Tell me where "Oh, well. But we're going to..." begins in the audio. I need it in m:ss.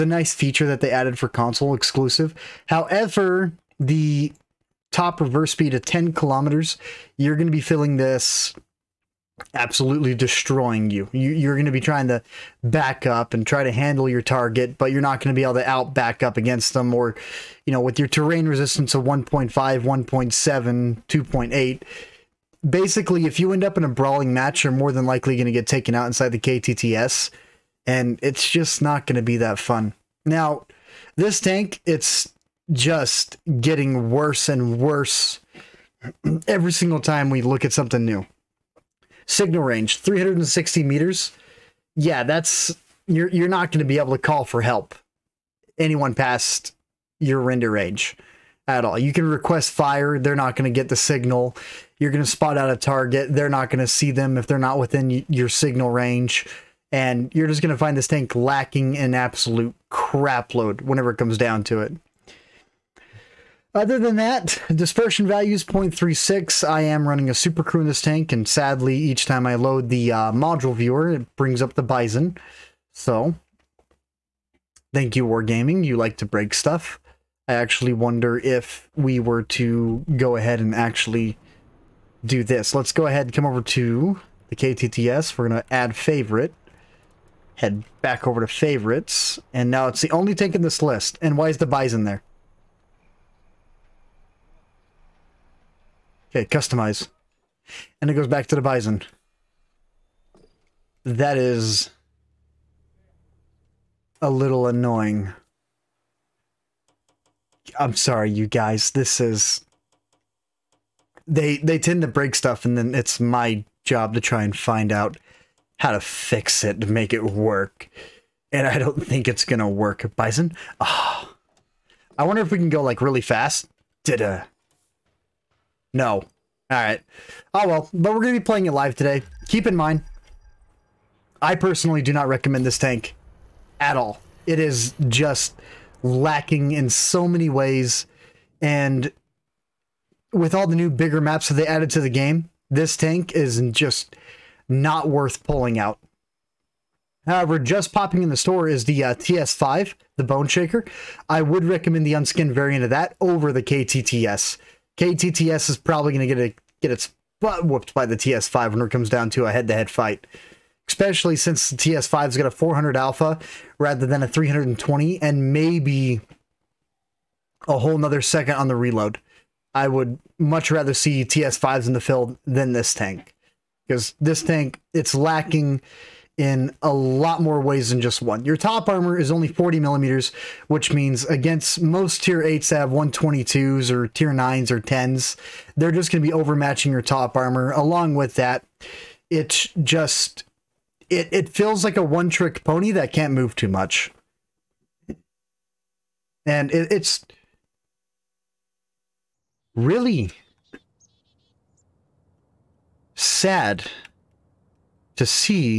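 2:07.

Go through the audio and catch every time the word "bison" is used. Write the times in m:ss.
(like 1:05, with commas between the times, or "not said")
1:11, 1:31, 1:38, 2:00.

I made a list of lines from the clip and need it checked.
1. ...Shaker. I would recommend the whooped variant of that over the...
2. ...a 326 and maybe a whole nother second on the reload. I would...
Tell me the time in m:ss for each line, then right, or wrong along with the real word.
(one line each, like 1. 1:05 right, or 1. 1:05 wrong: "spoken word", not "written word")
1. 2:30 wrong: "unskinned", not "whooped"
2. 2:44 wrong: "320", not "326".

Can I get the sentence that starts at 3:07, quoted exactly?
Along with that, it's just, it, it feels like a one trick pony that can't move too much.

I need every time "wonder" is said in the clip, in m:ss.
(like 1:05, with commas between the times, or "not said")
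1:17, 2:02.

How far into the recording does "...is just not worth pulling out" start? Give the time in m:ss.
2:23.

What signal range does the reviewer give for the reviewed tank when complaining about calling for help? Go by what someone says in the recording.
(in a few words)
360 meters.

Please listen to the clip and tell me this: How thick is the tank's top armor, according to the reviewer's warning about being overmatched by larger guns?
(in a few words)
40 millimeters.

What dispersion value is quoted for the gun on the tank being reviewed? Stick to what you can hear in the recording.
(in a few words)
0.36.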